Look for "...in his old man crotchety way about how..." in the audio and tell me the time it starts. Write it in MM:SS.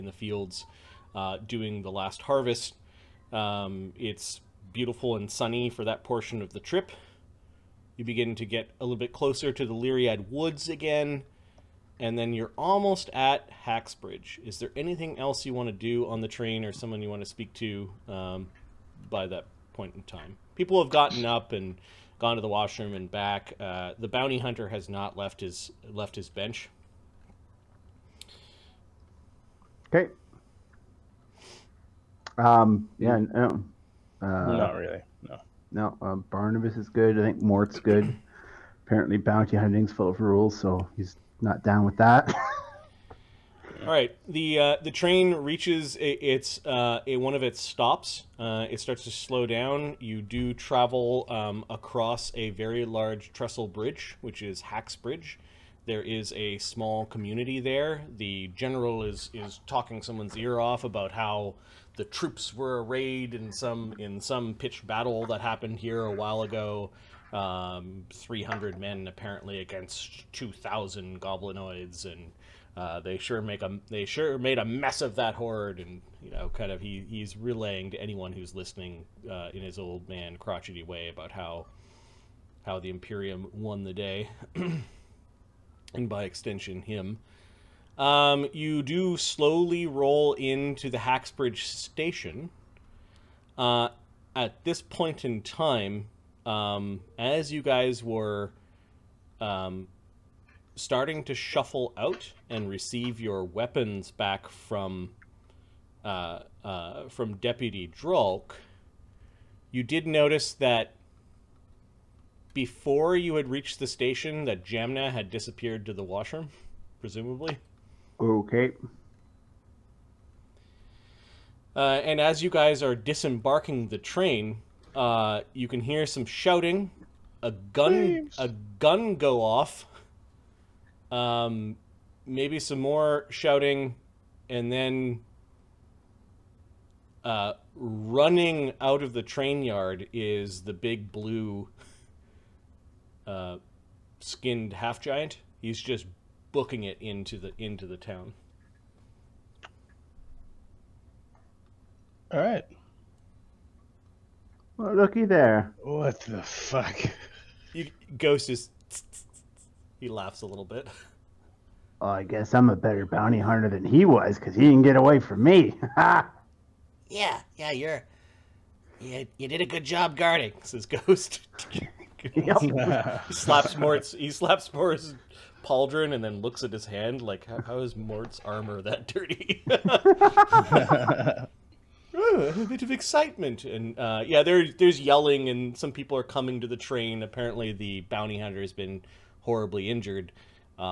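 01:19.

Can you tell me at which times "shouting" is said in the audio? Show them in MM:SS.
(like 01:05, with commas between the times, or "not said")
02:06, 02:13.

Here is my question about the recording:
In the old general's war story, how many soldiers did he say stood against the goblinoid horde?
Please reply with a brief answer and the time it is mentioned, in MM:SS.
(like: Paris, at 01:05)
300, at 01:08.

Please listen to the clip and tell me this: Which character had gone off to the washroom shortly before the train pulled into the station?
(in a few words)
Jamna.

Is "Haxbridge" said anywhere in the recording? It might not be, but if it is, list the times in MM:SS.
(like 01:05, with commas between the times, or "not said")
00:13, 00:54.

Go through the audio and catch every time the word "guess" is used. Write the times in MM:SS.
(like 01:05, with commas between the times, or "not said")
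02:42.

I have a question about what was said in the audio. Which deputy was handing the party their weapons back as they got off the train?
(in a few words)
Deputy Drulk.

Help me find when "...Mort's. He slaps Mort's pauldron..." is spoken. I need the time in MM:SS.
02:53.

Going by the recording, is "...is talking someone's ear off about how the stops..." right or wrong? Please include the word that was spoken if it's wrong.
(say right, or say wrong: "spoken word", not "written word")
wrong: "troops", not "stops".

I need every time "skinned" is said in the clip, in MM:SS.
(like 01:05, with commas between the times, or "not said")
02:24.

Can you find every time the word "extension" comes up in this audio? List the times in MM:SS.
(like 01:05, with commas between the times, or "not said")
01:26.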